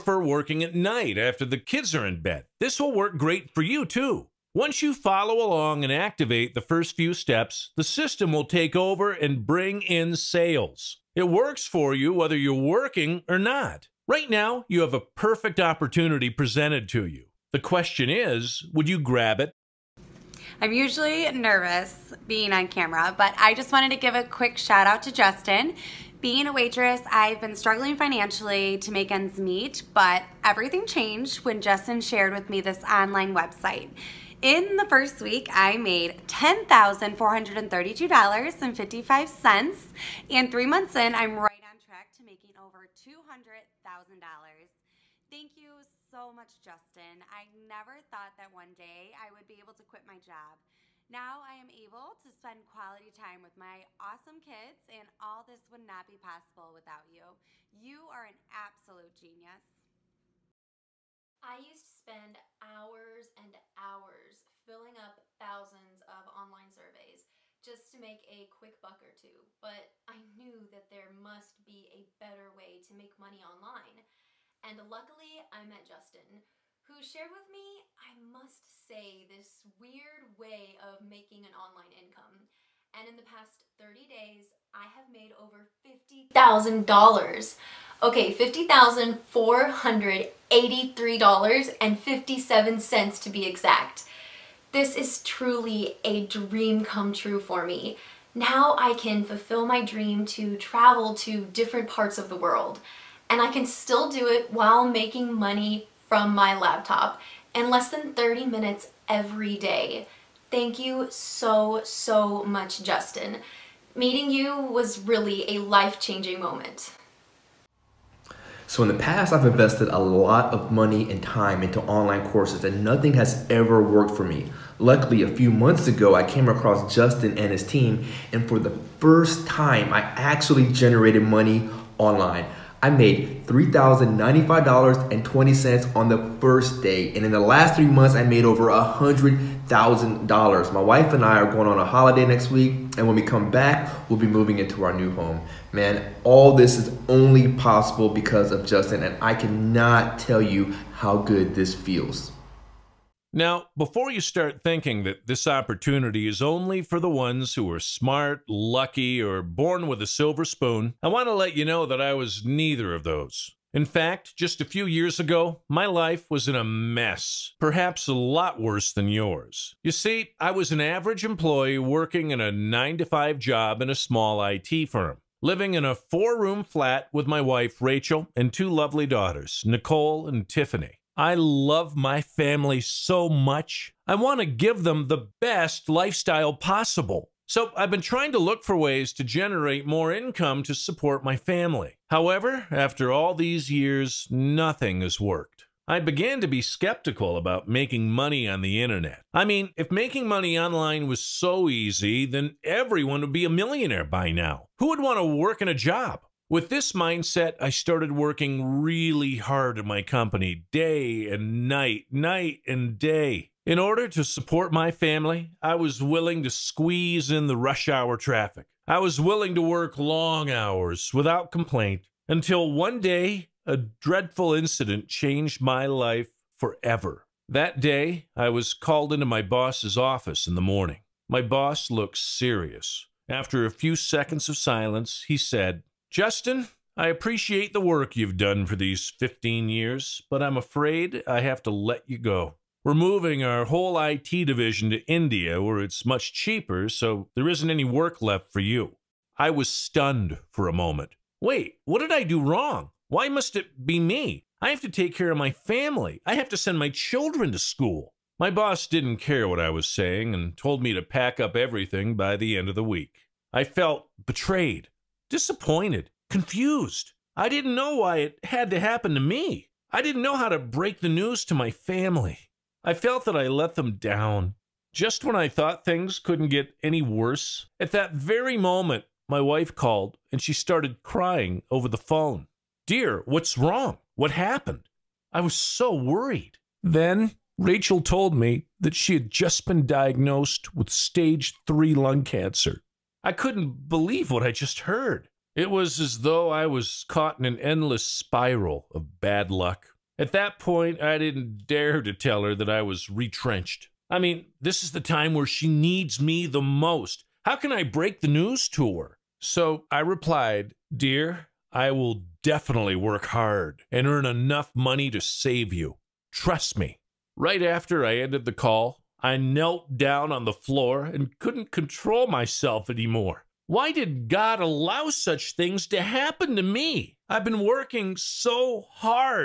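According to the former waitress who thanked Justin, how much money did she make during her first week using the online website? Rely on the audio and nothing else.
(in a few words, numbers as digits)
$10,432.55.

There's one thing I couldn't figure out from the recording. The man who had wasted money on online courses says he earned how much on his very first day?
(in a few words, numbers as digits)
$3,095.20.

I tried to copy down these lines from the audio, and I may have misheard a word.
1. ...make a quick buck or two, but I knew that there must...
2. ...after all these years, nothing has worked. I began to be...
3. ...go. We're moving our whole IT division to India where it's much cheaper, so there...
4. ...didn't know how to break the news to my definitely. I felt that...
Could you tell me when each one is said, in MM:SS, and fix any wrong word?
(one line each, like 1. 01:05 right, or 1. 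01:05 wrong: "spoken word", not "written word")
1. 01:07 right
2. 03:12 right
3. 04:02 right
4. 04:29 wrong: "family", not "definitely".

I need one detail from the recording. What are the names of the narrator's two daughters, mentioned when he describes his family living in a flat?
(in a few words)
Nicole and Tiffany.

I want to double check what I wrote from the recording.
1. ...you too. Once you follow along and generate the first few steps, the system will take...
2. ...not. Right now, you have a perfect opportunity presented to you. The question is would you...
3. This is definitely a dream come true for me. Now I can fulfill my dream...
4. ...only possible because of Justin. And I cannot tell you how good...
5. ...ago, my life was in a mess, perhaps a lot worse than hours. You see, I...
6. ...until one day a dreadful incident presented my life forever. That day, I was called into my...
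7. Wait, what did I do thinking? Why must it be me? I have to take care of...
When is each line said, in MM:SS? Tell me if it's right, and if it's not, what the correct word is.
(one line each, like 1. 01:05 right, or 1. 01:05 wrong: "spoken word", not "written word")
1. 00:03 wrong: "activate", not "generate"
2. 00:13 right
3. 01:34 wrong: "truly", not "definitely"
4. 02:27 right
5. 02:45 wrong: "yours", not "hours"
6. 03:42 wrong: "changed", not "presented"
7. 04:11 wrong: "wrong", not "thinking".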